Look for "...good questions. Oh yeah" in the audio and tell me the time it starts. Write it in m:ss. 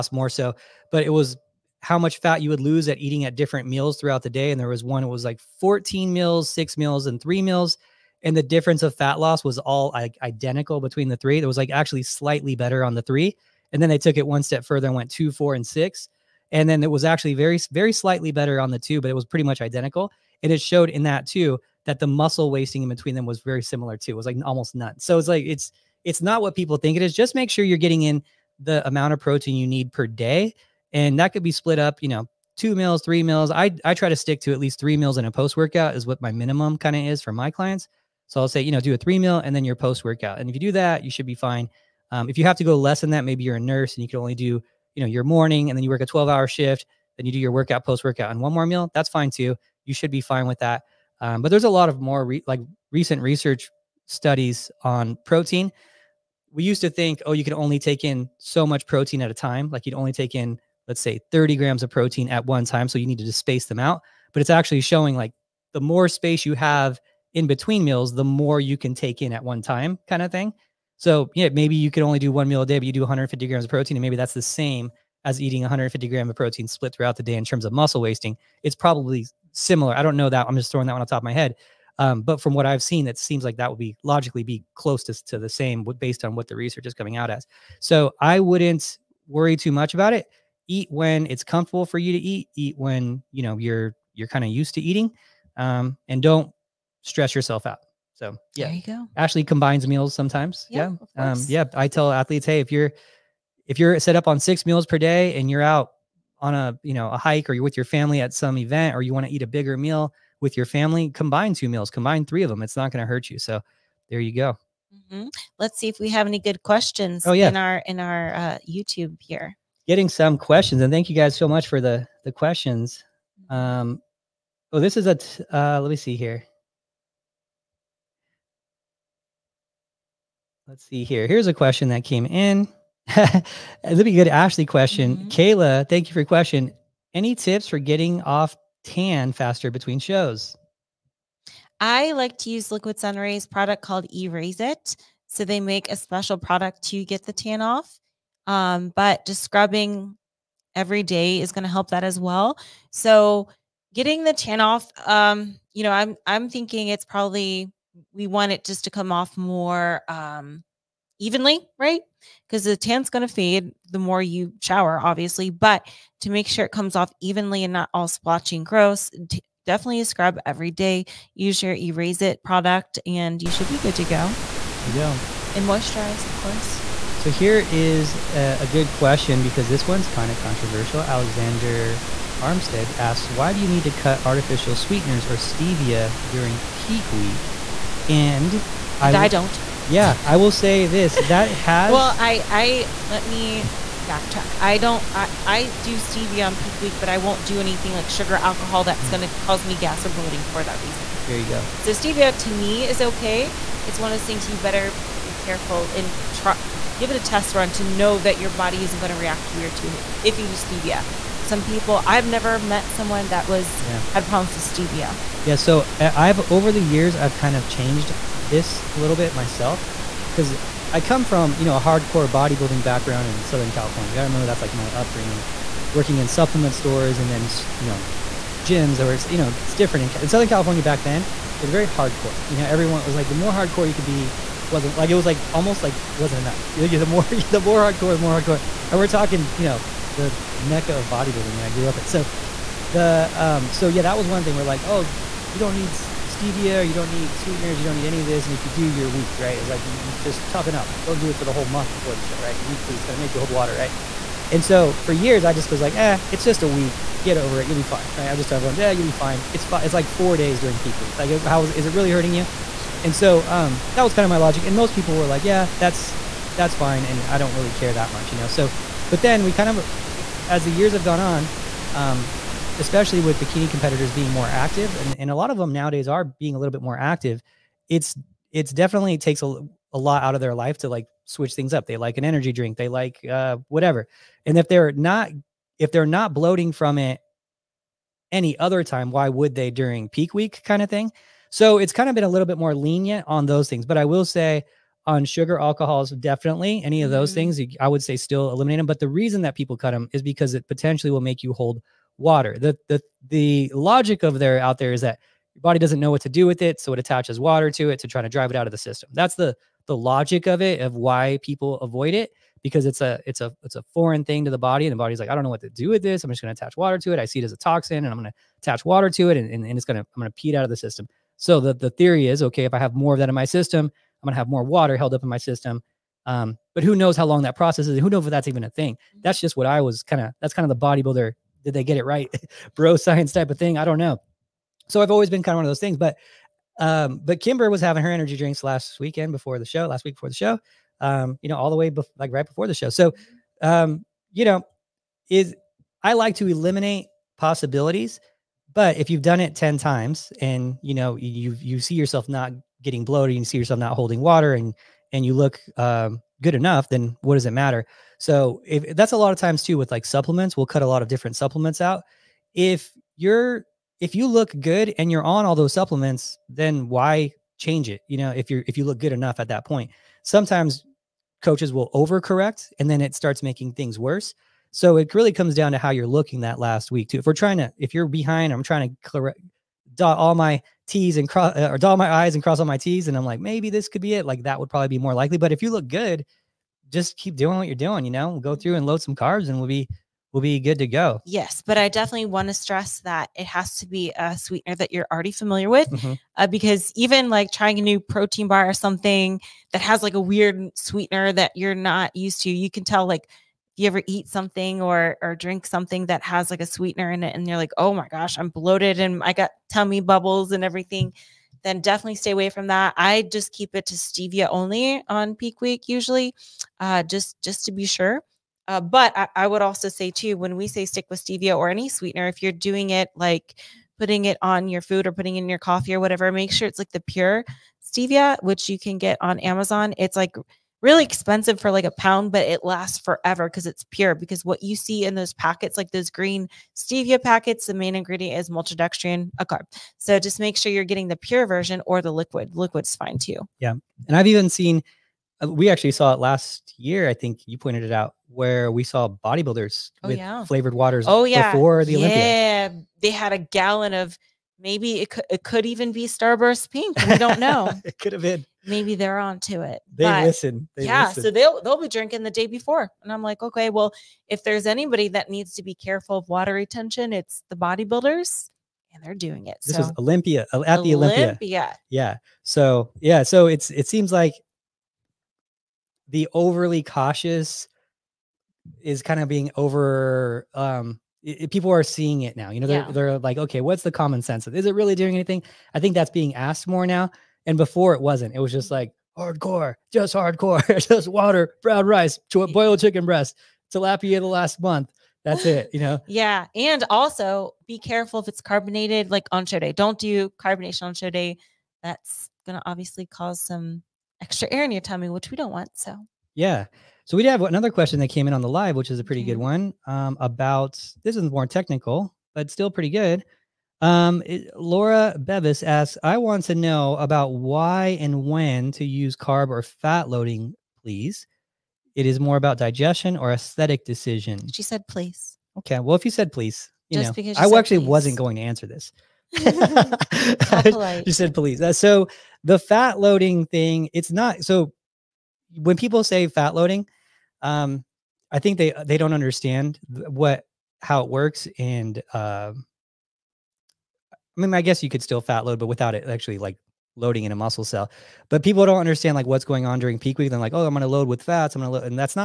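1:56.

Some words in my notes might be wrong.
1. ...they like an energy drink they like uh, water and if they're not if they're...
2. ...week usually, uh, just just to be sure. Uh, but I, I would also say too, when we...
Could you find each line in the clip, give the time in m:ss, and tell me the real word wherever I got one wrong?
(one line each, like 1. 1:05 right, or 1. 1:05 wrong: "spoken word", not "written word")
1. 4:41 wrong: "whatever", not "water"
2. 6:55 right.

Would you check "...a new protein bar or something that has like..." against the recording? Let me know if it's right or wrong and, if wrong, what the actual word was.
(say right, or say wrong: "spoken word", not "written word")
right.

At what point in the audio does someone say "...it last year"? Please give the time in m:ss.
7:26.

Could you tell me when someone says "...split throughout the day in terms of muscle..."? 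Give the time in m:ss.
1:16.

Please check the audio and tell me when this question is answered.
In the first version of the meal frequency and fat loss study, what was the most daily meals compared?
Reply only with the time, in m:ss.
0:05.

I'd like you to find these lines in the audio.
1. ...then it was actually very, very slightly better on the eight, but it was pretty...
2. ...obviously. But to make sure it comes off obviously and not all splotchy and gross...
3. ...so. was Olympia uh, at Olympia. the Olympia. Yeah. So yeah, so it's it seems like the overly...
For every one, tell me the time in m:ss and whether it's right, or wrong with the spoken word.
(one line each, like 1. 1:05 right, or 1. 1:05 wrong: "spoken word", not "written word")
1. 0:16 wrong: "two", not "eight"
2. 2:45 wrong: "evenly", not "obviously"
3. 7:49 right.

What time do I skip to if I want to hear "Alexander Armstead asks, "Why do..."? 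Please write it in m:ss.
3:00.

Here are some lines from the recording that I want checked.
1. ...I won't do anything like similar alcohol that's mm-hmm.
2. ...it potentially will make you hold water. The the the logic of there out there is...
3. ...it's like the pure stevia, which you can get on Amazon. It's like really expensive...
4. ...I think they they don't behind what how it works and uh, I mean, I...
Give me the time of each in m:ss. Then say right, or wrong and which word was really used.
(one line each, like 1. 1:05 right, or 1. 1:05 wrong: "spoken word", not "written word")
1. 3:17 wrong: "sugar", not "similar"
2. 5:00 right
3. 7:06 right
4. 8:58 wrong: "understand", not "behind".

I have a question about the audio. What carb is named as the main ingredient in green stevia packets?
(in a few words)
Maltodextrin.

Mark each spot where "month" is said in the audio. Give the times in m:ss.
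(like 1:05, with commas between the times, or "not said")
4:11, 8:14.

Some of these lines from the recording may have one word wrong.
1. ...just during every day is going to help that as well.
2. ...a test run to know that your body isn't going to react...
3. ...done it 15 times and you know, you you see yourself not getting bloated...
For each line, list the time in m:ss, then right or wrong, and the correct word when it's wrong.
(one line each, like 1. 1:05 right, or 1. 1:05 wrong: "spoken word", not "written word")
1. 2:29 wrong: "scrubbing", not "during"
2. 3:27 right
3. 5:49 wrong: "10", not "15".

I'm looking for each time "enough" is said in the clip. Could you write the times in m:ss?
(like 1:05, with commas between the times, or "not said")
3:56, 5:56, 6:09.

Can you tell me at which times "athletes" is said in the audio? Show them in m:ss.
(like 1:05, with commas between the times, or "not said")
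1:42.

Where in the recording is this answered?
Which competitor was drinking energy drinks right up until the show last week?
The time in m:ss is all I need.
5:37.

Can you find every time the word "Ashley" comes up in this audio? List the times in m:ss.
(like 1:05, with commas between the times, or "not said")
1:39, 2:14.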